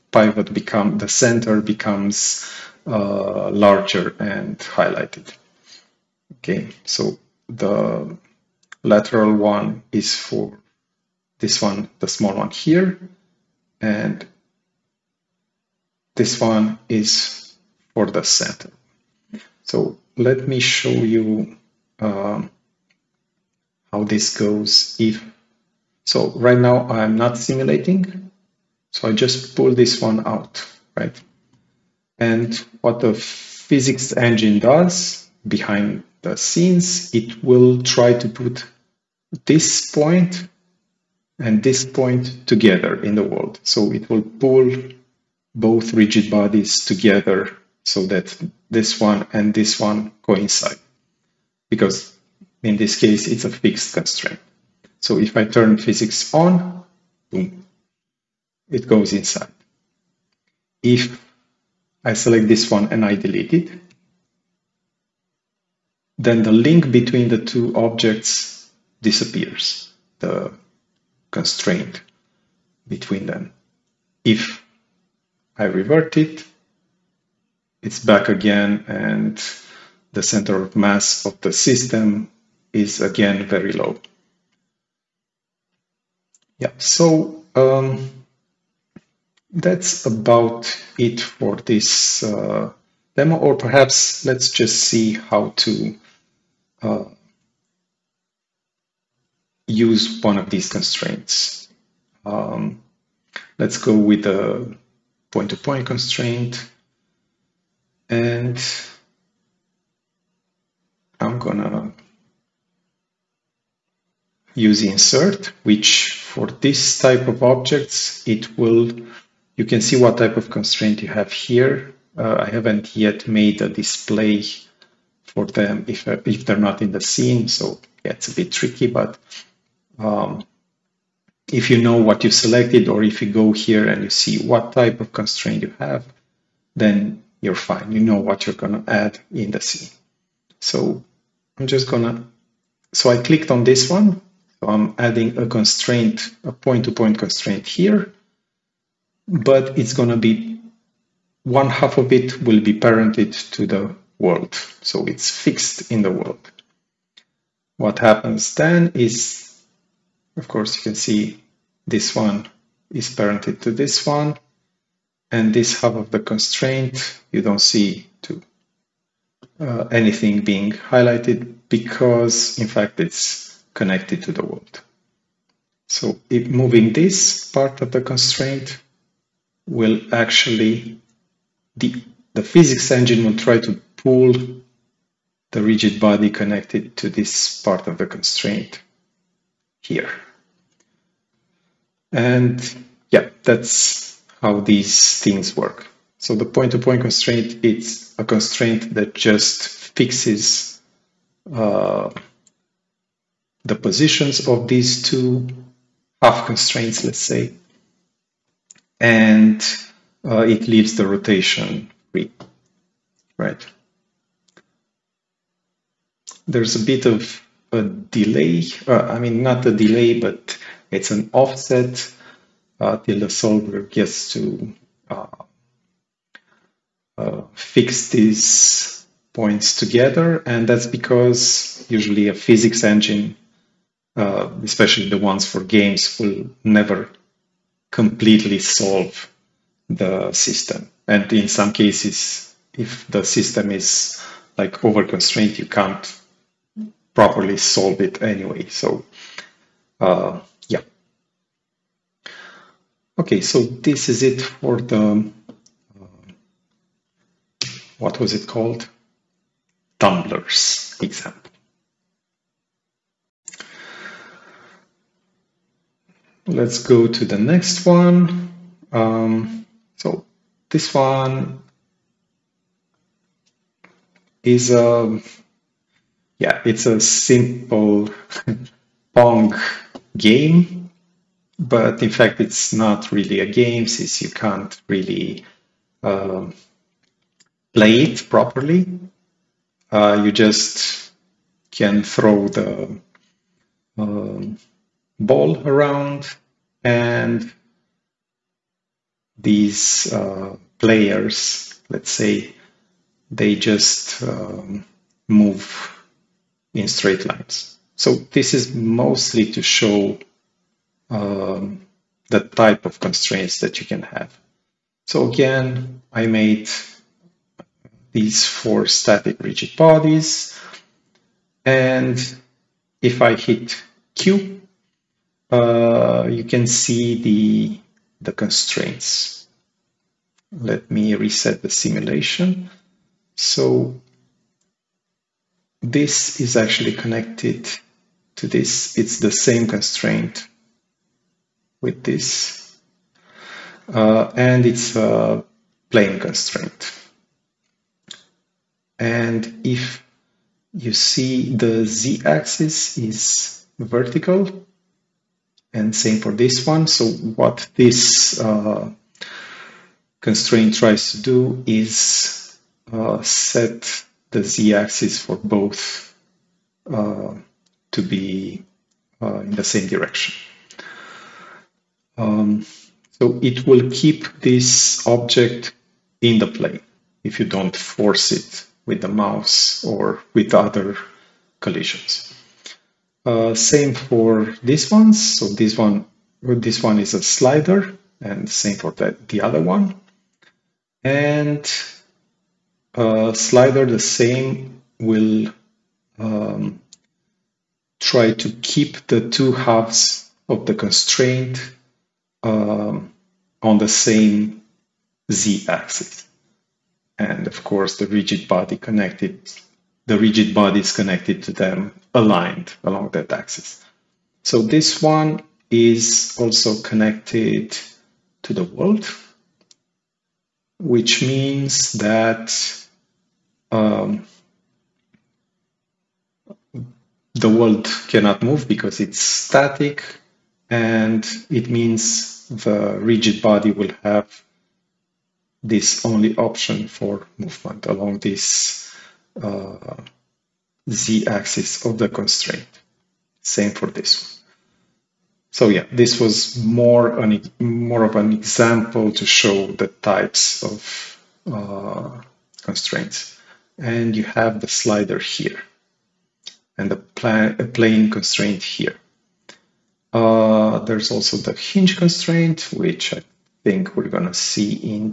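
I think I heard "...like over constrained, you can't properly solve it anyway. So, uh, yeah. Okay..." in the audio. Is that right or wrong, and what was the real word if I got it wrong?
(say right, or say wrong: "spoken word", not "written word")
right.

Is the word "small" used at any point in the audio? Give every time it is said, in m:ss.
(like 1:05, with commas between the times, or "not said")
0:12.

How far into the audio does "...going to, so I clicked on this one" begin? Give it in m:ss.
2:21.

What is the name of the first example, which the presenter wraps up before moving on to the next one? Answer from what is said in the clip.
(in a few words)
Tumblers.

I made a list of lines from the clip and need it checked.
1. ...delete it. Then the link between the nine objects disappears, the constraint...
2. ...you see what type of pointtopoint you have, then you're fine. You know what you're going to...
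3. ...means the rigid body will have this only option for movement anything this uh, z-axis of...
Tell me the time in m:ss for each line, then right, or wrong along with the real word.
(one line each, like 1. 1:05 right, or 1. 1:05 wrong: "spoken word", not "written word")
1. 1:03 wrong: "two", not "nine"
2. 2:14 wrong: "constraint", not "pointtopoint"
3. 7:11 wrong: "along", not "anything".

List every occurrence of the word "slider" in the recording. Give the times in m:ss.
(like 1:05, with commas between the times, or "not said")
6:27, 6:33, 7:34.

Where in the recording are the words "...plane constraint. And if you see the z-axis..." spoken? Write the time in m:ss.
5:45.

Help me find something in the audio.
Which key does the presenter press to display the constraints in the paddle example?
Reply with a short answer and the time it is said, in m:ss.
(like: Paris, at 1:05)
Q, at 5:24.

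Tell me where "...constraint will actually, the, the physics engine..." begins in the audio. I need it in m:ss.
2:58.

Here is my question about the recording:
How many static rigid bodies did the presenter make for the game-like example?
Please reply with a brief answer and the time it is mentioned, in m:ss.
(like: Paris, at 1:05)
4, at 5:18.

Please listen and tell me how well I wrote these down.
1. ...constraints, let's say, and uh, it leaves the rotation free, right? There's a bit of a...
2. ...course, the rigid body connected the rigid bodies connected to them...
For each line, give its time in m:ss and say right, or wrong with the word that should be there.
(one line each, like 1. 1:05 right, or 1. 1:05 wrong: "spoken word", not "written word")
1. 3:26 right
2. 6:47 right.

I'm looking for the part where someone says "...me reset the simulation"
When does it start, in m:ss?
5:30.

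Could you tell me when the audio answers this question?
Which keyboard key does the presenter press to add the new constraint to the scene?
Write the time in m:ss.
1:54.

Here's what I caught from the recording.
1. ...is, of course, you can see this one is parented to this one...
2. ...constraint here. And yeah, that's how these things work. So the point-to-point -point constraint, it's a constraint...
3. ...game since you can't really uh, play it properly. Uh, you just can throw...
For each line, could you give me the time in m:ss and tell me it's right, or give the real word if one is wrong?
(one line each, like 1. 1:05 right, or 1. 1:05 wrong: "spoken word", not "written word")
1. 2:38 right
2. 3:08 right
3. 4:43 right.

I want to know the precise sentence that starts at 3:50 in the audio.
And that's because usually a physics engine, uh, especially the ones for games, will never completely solve the system.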